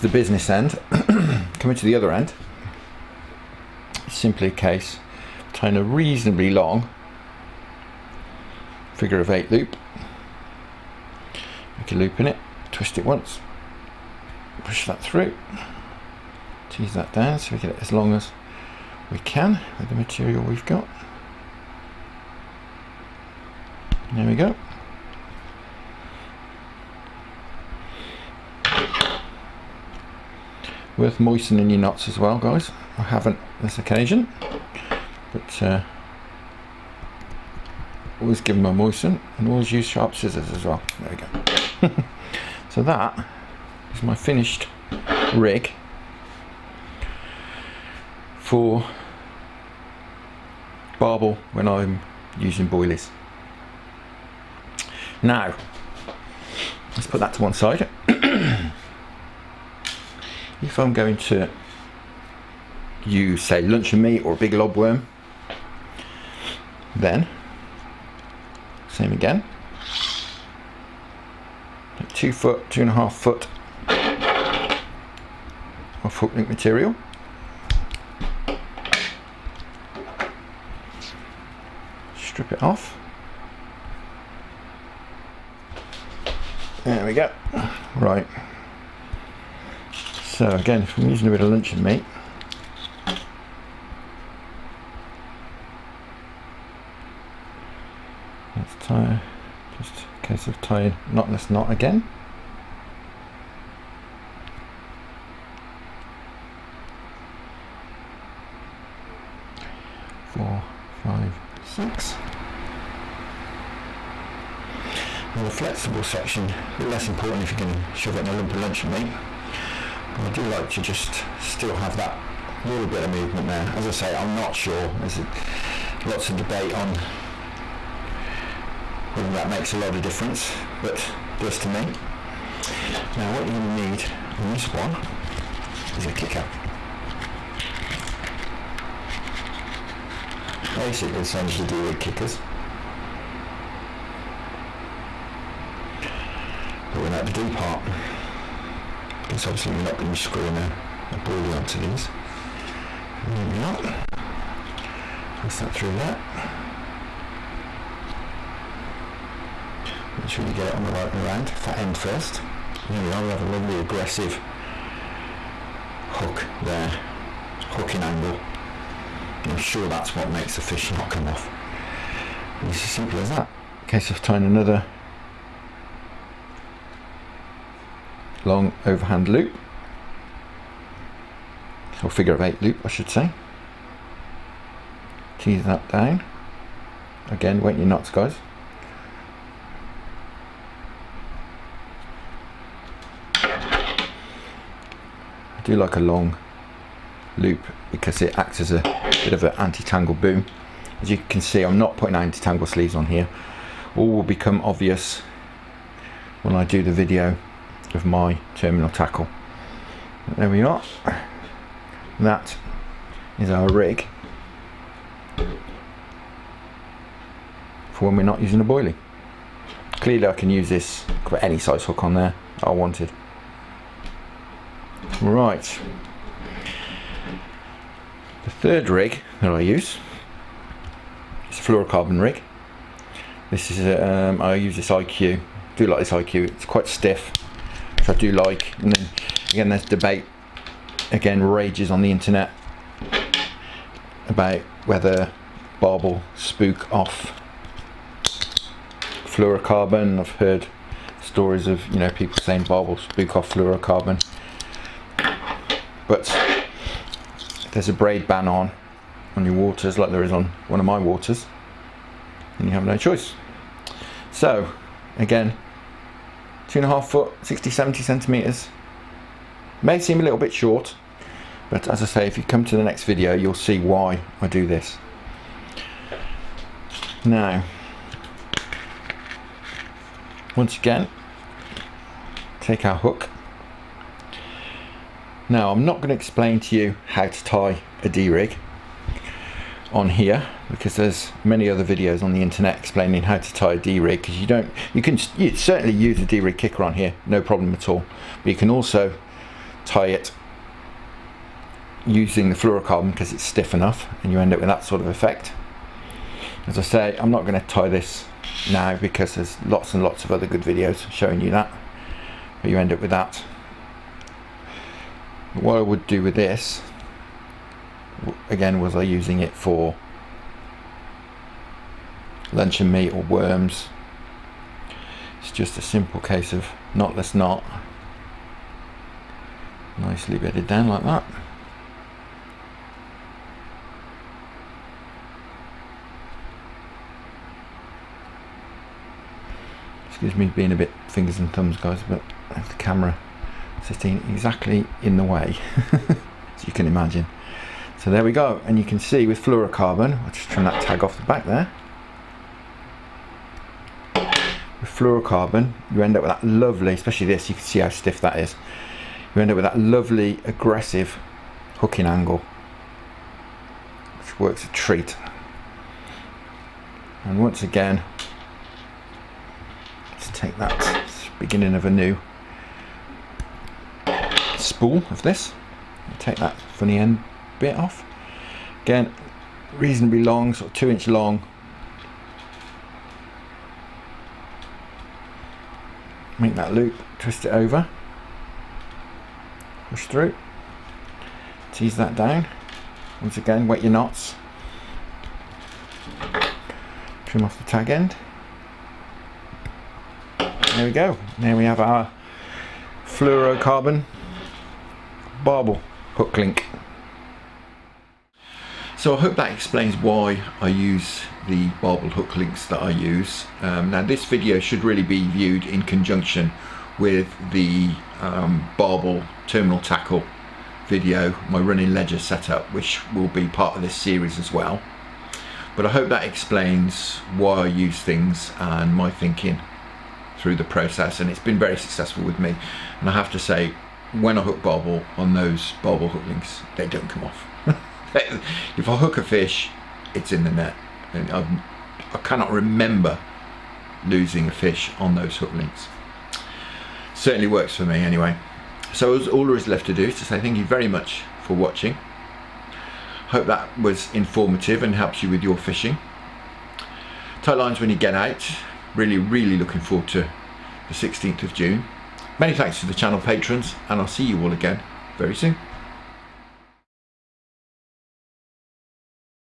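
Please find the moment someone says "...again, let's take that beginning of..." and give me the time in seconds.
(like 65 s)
367 s.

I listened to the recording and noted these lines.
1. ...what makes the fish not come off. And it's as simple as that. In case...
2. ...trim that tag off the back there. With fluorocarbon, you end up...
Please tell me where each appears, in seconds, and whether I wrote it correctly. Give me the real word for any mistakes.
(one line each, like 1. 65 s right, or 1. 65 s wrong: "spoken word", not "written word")
1. 170 s right
2. 350 s right.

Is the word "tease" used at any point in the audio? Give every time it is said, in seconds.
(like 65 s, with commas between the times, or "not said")
16 s, 185 s, 391 s.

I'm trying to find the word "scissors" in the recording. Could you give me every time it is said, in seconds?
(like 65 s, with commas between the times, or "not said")
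40 s.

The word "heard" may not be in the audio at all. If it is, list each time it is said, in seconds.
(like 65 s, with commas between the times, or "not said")
250 s.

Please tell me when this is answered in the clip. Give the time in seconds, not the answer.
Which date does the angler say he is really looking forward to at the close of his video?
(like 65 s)
460 s.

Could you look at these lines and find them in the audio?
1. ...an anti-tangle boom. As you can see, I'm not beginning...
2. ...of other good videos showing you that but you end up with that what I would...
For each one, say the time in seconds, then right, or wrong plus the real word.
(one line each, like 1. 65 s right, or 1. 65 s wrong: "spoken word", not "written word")
1. 199 s wrong: "putting", not "beginning"
2. 310 s right.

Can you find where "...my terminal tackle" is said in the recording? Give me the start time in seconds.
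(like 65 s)
208 s.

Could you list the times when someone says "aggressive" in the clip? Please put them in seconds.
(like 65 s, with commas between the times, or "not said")
163 s, 360 s.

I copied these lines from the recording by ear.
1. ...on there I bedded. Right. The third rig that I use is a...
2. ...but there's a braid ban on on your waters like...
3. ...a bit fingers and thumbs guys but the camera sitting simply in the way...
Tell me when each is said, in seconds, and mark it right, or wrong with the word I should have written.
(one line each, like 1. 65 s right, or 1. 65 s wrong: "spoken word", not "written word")
1. 222 s wrong: "wanted", not "bedded"
2. 256 s right
3. 340 s wrong: "exactly", not "simply".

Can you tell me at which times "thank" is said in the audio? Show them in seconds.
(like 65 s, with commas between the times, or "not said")
450 s, 462 s.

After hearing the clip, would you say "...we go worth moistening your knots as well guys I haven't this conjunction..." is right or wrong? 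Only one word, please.
wrong.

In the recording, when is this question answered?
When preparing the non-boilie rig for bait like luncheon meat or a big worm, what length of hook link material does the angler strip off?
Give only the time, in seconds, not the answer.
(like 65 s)
72 s.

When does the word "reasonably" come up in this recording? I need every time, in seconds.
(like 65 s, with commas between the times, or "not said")
5 s, 379 s.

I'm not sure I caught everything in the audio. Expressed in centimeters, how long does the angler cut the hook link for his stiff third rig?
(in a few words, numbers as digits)
60-70 centimeters.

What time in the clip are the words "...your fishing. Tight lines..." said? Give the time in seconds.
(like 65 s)
455 s.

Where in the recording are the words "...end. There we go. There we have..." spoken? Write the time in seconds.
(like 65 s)
397 s.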